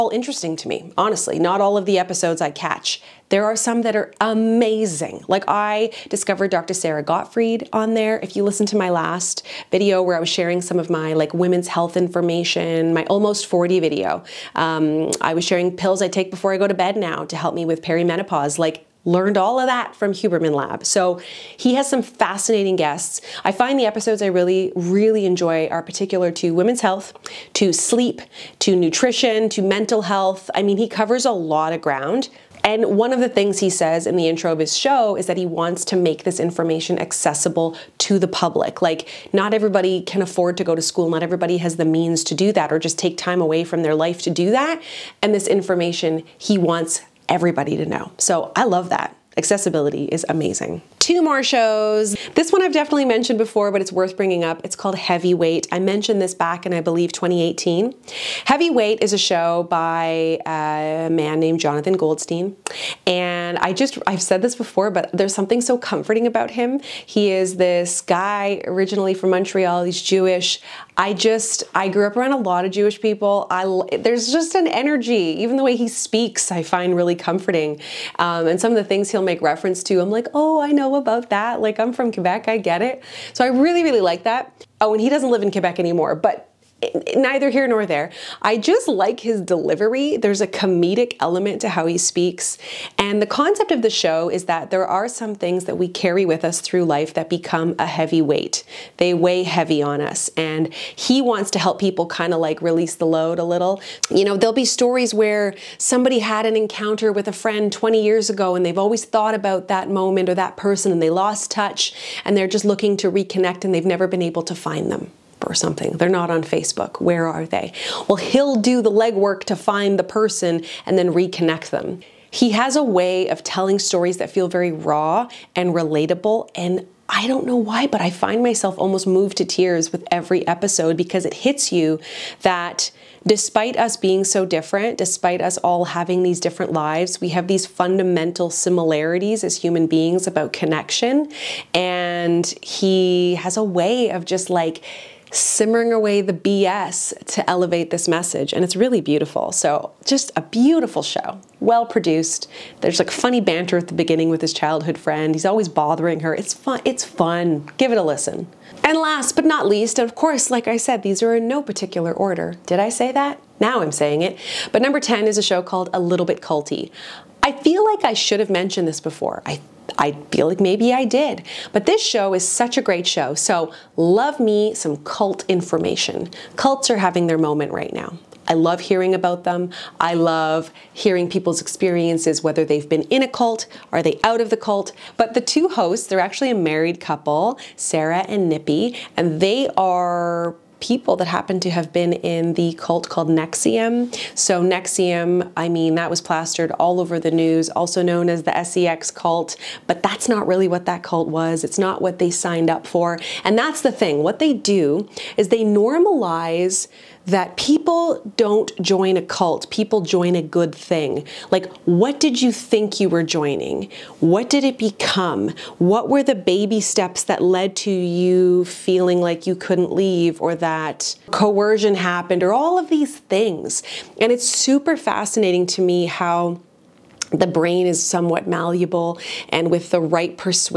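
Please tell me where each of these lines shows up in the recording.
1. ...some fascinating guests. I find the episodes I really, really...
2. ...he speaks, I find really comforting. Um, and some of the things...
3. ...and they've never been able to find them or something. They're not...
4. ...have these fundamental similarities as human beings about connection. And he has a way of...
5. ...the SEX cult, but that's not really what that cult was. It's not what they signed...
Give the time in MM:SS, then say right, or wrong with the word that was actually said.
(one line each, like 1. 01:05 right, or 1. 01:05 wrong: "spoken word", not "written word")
1. 00:21 right
2. 01:15 right
3. 01:53 right
4. 02:17 right
5. 03:18 right.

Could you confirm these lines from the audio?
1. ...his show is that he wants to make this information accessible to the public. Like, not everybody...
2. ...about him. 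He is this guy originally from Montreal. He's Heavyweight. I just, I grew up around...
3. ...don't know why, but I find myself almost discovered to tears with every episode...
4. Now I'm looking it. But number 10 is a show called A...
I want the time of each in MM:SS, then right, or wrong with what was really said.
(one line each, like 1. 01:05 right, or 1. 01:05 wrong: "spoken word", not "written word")
1. 00:34 right
2. 01:06 wrong: "Jewish", not "Heavyweight"
3. 02:07 wrong: "moved", not "discovered"
4. 02:43 wrong: "saying", not "looking".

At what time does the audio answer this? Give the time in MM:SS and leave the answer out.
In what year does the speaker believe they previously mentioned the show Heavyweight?
00:57.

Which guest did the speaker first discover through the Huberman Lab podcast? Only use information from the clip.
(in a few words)
Dr. Sara Gottfried.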